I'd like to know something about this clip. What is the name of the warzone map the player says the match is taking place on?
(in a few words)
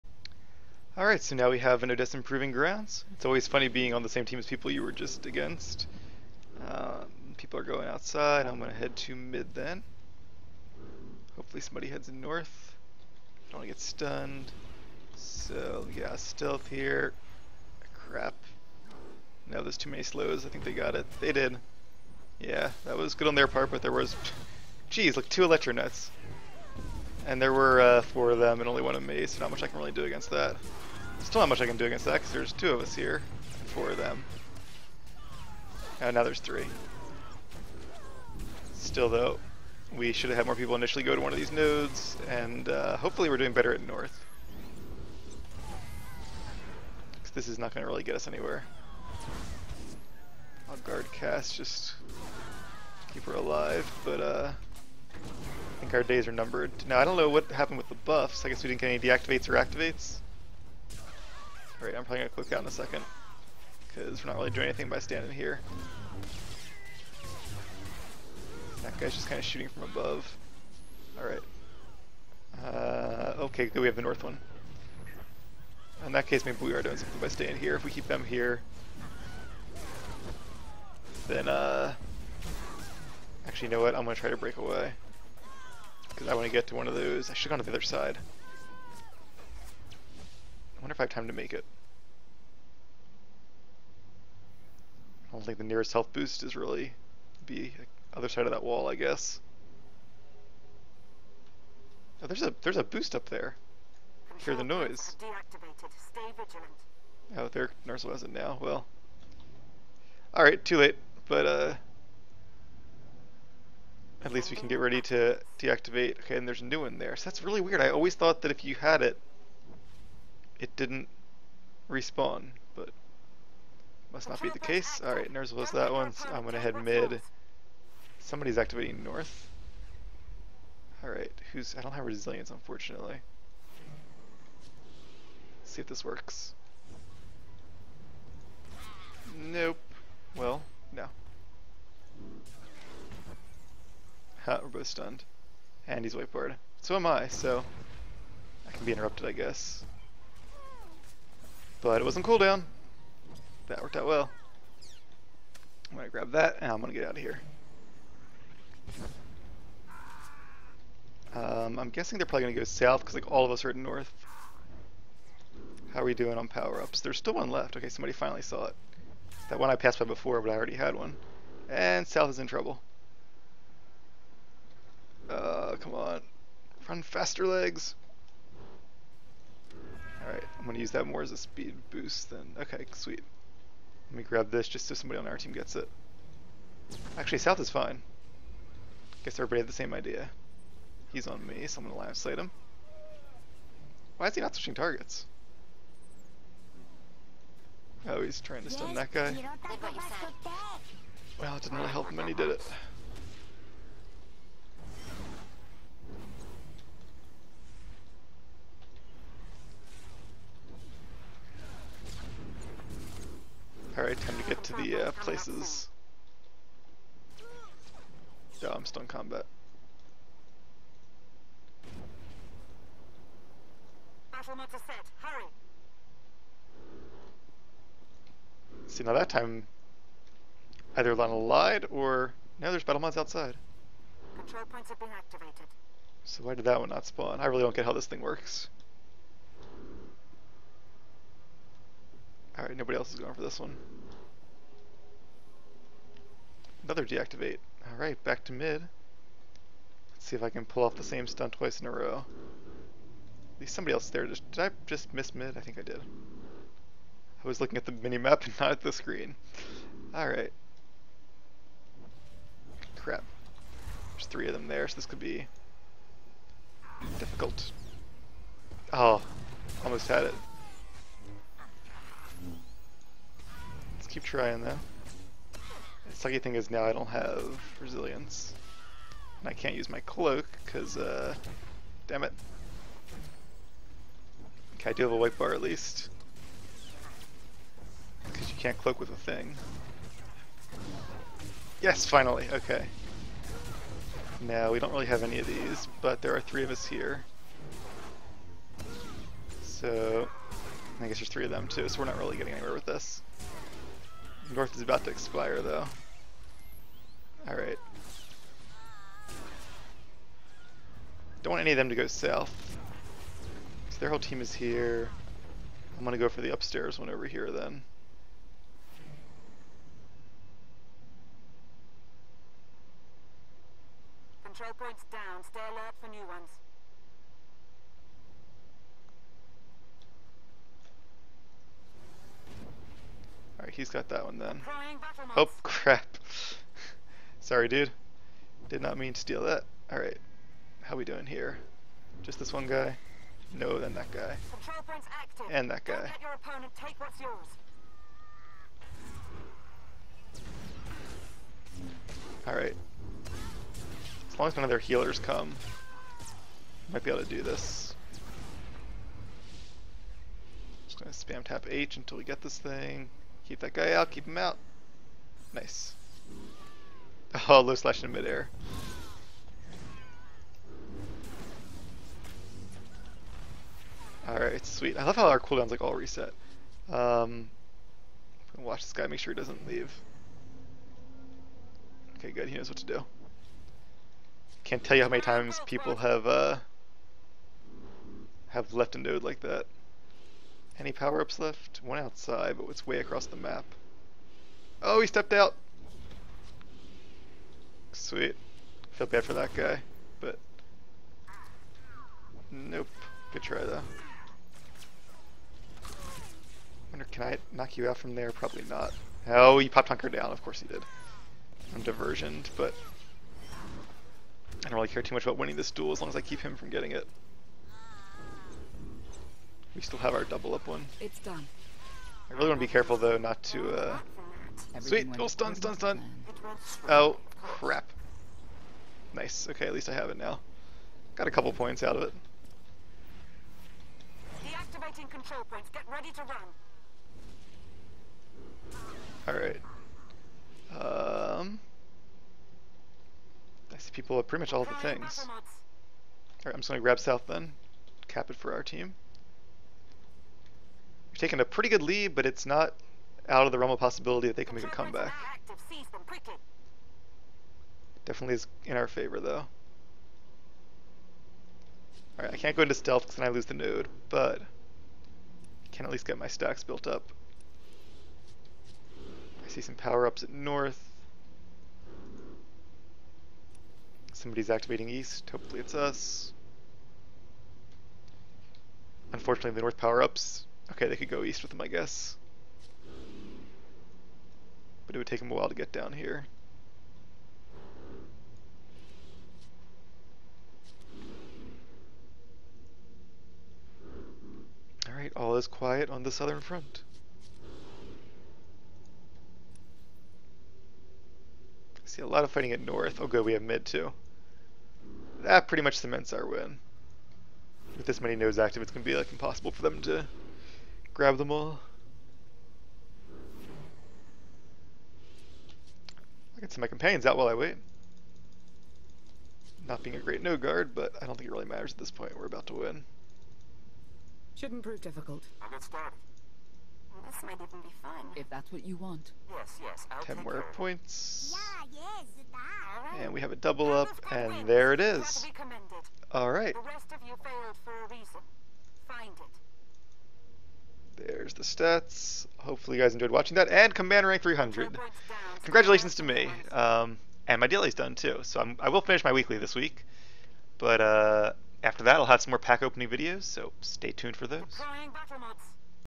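Odessen Proving Grounds.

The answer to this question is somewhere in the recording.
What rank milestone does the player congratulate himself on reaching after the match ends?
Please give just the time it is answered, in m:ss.
9:03.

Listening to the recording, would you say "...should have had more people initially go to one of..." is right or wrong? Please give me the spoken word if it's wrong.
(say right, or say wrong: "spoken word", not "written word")
right.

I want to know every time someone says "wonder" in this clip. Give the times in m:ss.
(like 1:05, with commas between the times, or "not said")
1:30, 6:46.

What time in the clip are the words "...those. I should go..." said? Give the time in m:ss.
1:26.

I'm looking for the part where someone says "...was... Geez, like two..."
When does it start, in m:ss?
0:23.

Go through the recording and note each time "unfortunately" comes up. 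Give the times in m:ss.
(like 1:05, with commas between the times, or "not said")
2:12, 7:59.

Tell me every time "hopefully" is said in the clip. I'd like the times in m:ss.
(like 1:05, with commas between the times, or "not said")
0:11, 0:42, 7:55, 9:02.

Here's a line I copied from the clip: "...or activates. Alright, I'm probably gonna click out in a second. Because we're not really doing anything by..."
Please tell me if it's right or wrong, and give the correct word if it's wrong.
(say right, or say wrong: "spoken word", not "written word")
right.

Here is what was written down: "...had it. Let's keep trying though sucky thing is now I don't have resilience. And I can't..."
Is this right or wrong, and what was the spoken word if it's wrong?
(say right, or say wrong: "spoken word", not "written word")
right.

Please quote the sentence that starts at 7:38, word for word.
Definitely is in our favor, though.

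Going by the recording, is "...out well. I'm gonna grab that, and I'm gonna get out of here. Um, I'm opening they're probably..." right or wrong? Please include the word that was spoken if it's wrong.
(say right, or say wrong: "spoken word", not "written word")
wrong: "guessing", not "opening".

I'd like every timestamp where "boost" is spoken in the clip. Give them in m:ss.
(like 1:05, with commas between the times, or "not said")
1:36, 1:42, 3:01.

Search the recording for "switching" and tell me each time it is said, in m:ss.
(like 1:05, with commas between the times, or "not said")
3:14.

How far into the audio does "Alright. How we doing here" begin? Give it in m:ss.
5:39.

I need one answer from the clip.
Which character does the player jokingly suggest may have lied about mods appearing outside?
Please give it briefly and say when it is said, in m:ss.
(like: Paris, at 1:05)
Lana, at 3:51.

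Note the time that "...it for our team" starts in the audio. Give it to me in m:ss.
7:28.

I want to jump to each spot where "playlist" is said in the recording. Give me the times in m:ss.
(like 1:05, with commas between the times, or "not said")
not said.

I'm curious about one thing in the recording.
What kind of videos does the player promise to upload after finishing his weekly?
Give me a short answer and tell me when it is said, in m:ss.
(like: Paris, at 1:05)
pack opening videos, at 9:12.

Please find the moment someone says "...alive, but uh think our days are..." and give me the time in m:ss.
0:53.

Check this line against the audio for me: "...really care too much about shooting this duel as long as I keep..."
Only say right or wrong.
wrong.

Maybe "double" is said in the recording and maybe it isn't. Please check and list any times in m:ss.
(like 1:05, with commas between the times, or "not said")
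7:00, 8:53.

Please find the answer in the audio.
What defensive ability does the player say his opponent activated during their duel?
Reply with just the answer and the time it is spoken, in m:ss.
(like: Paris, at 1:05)
Hunker down, at 6:49.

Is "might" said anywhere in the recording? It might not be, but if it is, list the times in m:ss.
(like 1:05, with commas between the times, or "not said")
5:56, 8:47.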